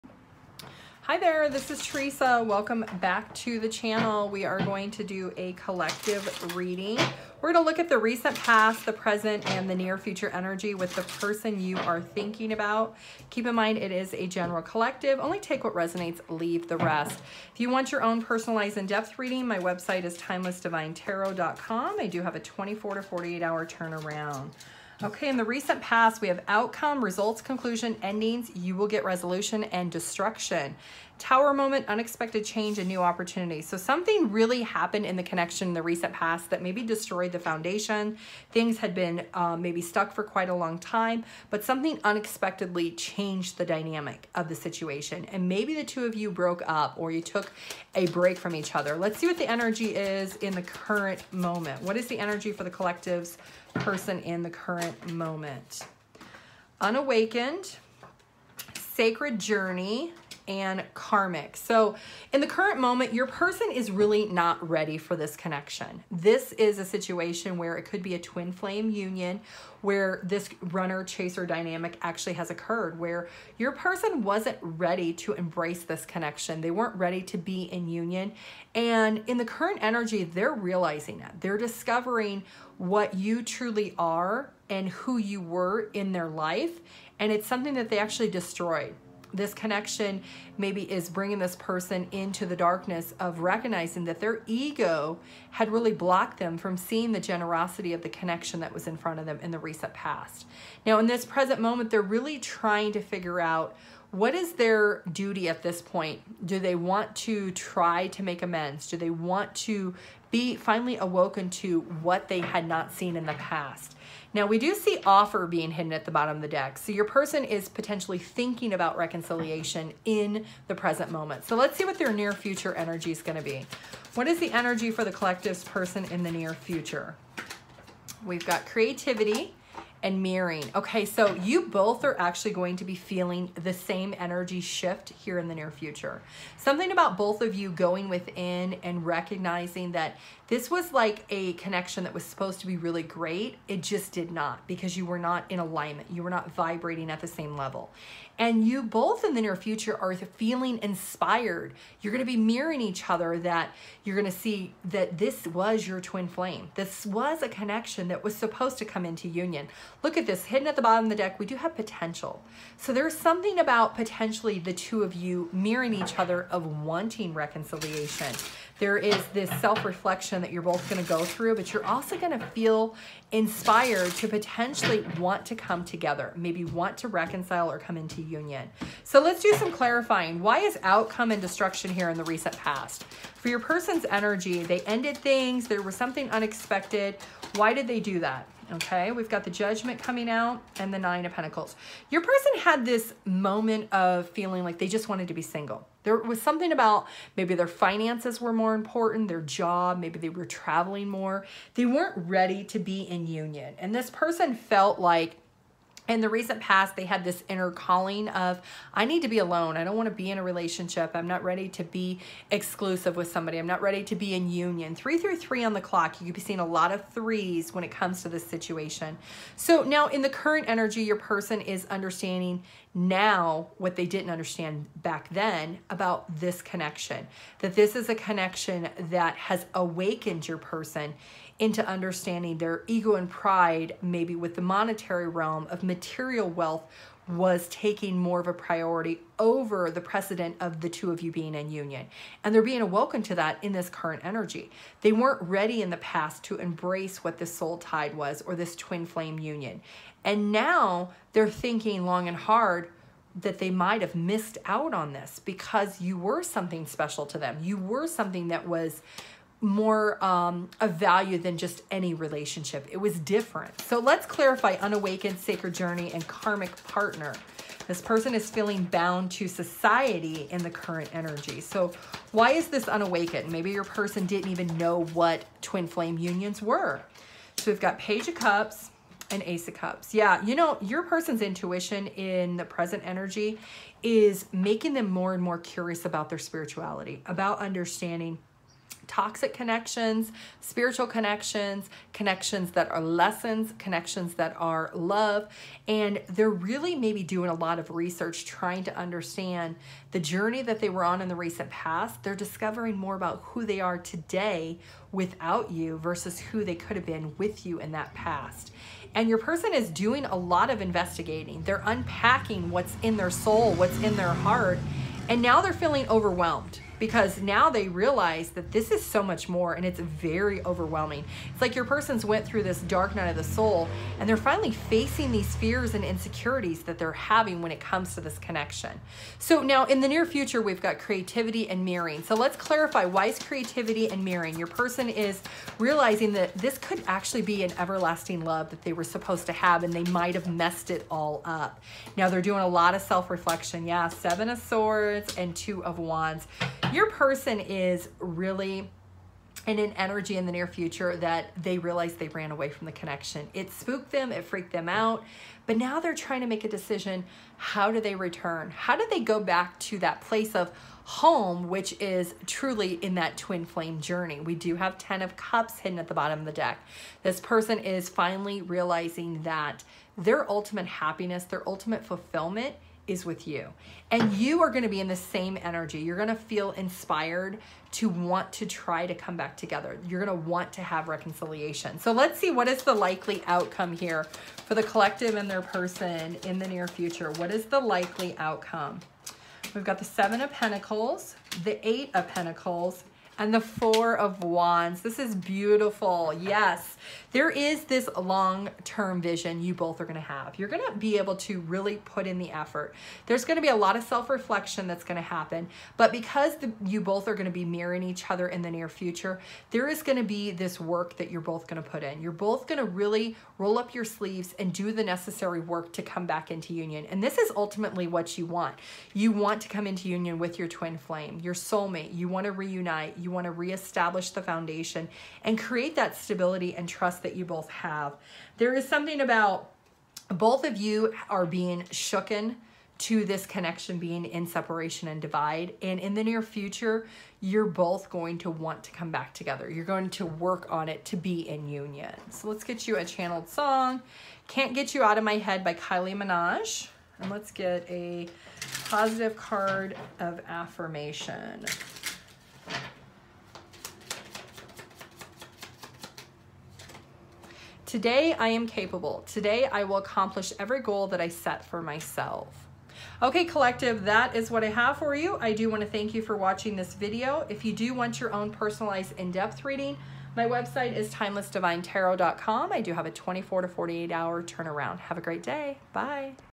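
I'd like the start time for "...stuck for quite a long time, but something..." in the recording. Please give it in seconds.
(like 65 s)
39 s.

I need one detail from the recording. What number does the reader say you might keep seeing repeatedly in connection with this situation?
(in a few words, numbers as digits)
3.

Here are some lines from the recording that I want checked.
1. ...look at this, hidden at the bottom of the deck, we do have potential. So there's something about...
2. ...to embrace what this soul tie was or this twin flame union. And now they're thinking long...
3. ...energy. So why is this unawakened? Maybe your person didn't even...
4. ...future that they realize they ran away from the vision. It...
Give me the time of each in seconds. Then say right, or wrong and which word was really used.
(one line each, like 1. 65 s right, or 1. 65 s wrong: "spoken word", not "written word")
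1. 160 s right
2. 246 s right
3. 271 s right
4. 350 s wrong: "connection", not "vision".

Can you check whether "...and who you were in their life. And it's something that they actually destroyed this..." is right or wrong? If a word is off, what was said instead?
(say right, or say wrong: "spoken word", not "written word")
right.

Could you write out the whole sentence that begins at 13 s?
Keep in mind, it is a general collective.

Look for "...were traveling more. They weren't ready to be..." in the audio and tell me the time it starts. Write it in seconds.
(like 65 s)
200 s.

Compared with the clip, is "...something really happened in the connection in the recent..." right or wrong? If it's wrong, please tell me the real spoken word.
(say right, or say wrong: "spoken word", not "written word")
right.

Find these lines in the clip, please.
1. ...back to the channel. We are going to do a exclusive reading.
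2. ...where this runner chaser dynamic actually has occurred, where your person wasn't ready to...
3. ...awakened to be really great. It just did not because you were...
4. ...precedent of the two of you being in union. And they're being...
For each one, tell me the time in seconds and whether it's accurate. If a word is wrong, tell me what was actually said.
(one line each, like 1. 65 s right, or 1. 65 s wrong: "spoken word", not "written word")
1. 3 s wrong: "collective", not "exclusive"
2. 69 s right
3. 142 s wrong: "supposed", not "awakened"
4. 240 s right.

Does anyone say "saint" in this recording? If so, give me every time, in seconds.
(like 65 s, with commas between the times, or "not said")
not said.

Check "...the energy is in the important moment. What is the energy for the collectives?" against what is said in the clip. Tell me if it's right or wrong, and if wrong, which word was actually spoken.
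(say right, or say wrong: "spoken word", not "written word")
wrong: "current", not "important".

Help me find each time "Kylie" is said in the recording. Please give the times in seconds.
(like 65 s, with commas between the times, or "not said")
445 s.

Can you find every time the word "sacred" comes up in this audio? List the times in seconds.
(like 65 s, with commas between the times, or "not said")
58 s, 265 s.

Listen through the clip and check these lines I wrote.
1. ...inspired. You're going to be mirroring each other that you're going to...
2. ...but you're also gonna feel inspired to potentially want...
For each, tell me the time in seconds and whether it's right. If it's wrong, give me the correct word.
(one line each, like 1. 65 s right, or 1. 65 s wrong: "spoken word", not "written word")
1. 150 s right
2. 171 s right.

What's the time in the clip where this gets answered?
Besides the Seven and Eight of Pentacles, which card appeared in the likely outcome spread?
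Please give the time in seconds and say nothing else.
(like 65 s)
393 s.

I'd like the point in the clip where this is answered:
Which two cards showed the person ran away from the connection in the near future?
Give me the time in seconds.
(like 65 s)
344 s.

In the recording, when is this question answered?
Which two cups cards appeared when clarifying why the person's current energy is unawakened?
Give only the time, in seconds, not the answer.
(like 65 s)
277 s.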